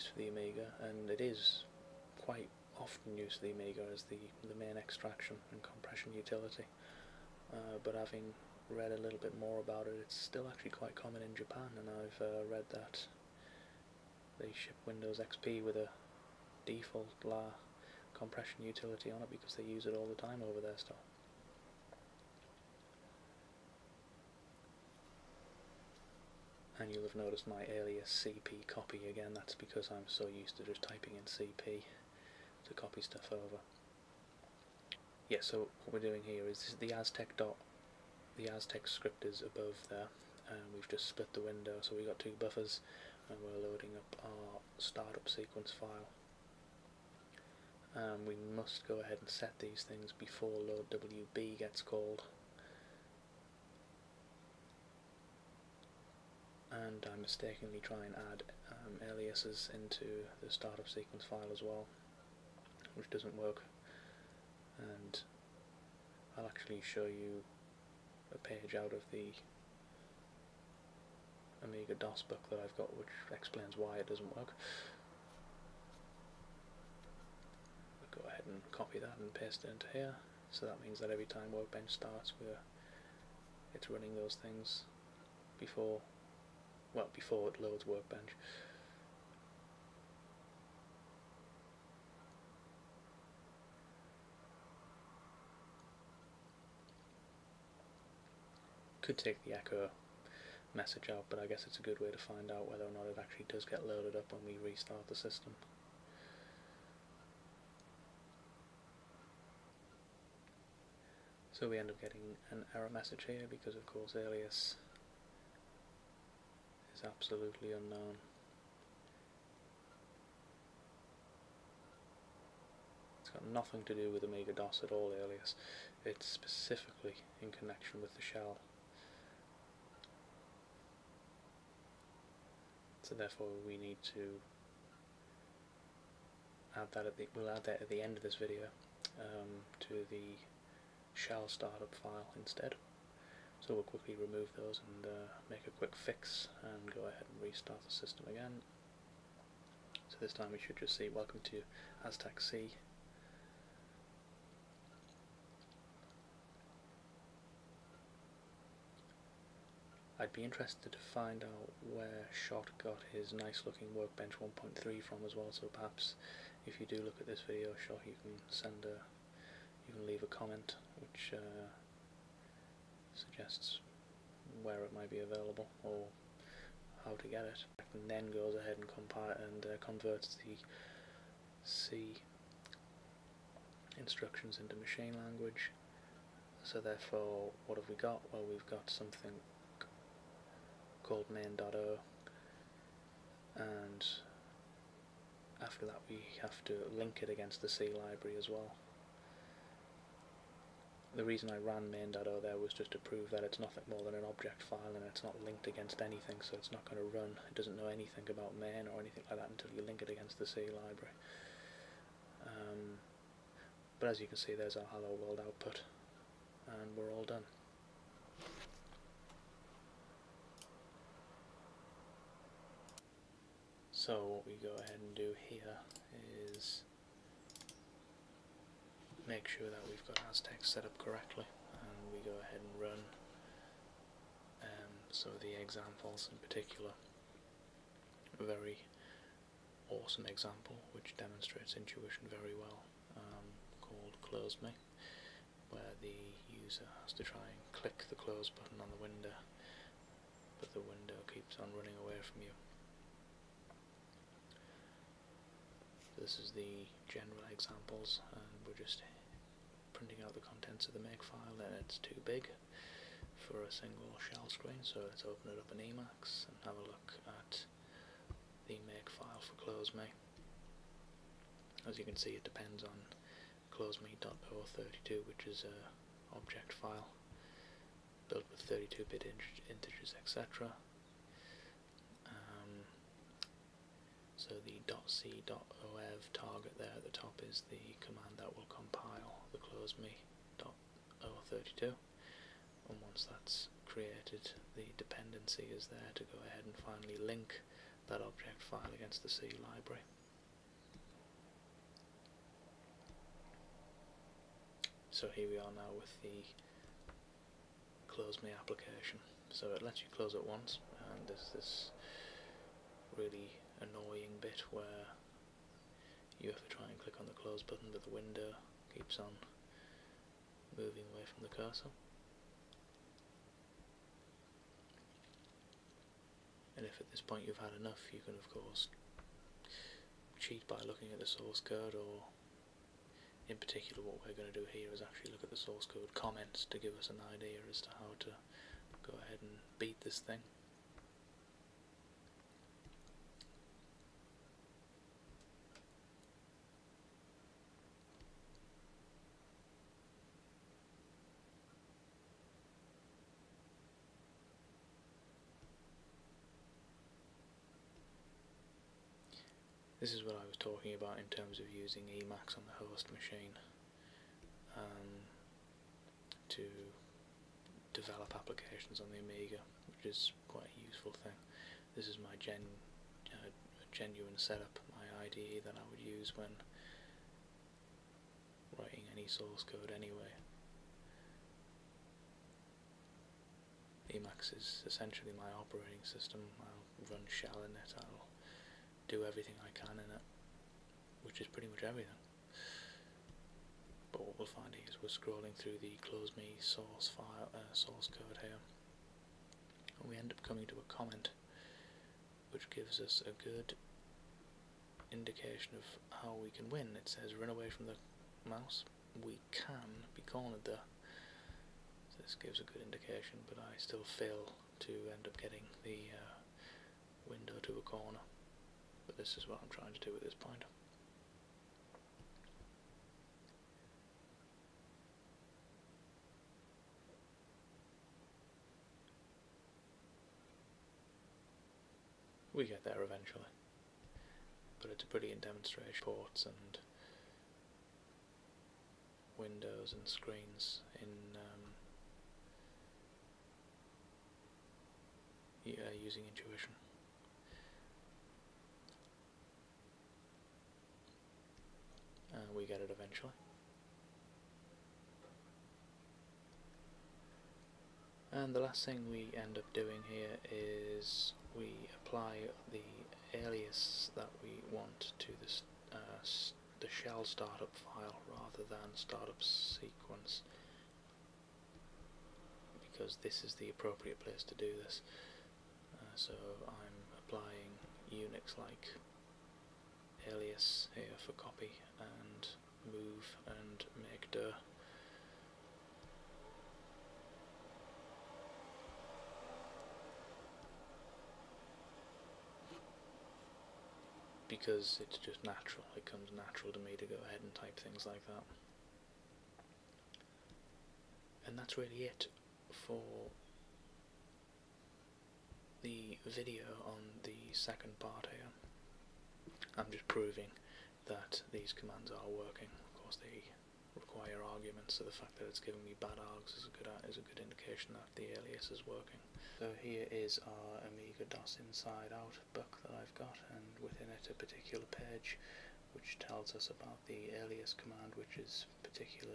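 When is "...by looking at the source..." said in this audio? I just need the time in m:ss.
5:30.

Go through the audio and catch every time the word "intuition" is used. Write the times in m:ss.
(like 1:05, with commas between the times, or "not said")
4:01, 7:26.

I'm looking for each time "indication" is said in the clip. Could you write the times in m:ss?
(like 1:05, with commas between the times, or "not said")
6:45, 6:52, 8:37.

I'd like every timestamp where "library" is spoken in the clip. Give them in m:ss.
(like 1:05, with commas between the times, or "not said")
3:17, 3:30, 4:59.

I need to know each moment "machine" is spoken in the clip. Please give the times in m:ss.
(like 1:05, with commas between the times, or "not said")
3:04, 6:03.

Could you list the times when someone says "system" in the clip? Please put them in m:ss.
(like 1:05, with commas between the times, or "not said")
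1:45, 2:27, 6:26.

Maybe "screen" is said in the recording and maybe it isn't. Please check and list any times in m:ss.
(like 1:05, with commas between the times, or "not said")
4:24, 7:20.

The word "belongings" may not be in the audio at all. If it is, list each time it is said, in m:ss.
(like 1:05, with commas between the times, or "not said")
not said.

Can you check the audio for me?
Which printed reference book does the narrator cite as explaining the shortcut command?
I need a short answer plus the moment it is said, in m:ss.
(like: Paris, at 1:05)
Amiga DOS Inside Out, at 8:40.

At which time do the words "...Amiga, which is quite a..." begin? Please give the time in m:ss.
6:09.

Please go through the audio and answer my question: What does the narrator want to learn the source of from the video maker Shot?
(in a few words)
Workbench 1.3.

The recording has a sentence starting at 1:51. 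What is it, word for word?
So we end up getting an error message here because of course alias is absolutely unknown.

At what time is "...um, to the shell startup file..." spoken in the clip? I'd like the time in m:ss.
2:19.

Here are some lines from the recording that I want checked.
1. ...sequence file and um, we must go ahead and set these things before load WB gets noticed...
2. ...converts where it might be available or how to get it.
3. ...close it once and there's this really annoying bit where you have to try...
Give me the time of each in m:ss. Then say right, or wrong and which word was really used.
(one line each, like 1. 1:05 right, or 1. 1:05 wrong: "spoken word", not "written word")
1. 0:45 wrong: "called", not "noticed"
2. 2:53 wrong: "suggests", not "converts"
3. 5:10 right.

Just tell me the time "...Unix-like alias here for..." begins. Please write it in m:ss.
7:58.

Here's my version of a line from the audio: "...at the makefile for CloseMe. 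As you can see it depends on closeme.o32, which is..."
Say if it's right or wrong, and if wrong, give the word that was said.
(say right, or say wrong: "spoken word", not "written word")
right.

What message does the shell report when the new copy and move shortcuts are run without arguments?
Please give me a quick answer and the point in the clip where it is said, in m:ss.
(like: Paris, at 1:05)
bad args, at 8:36.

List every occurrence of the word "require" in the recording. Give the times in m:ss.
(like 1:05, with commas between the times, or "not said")
8:33.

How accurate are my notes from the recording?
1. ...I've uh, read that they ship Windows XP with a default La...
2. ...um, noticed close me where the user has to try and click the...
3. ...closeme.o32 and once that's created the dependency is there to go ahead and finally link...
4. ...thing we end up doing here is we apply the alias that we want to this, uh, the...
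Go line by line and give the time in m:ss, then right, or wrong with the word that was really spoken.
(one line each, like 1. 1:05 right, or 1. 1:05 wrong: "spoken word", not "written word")
1. 0:11 right
2. 4:03 wrong: "called", not "noticed"
3. 4:49 right
4. 7:38 right.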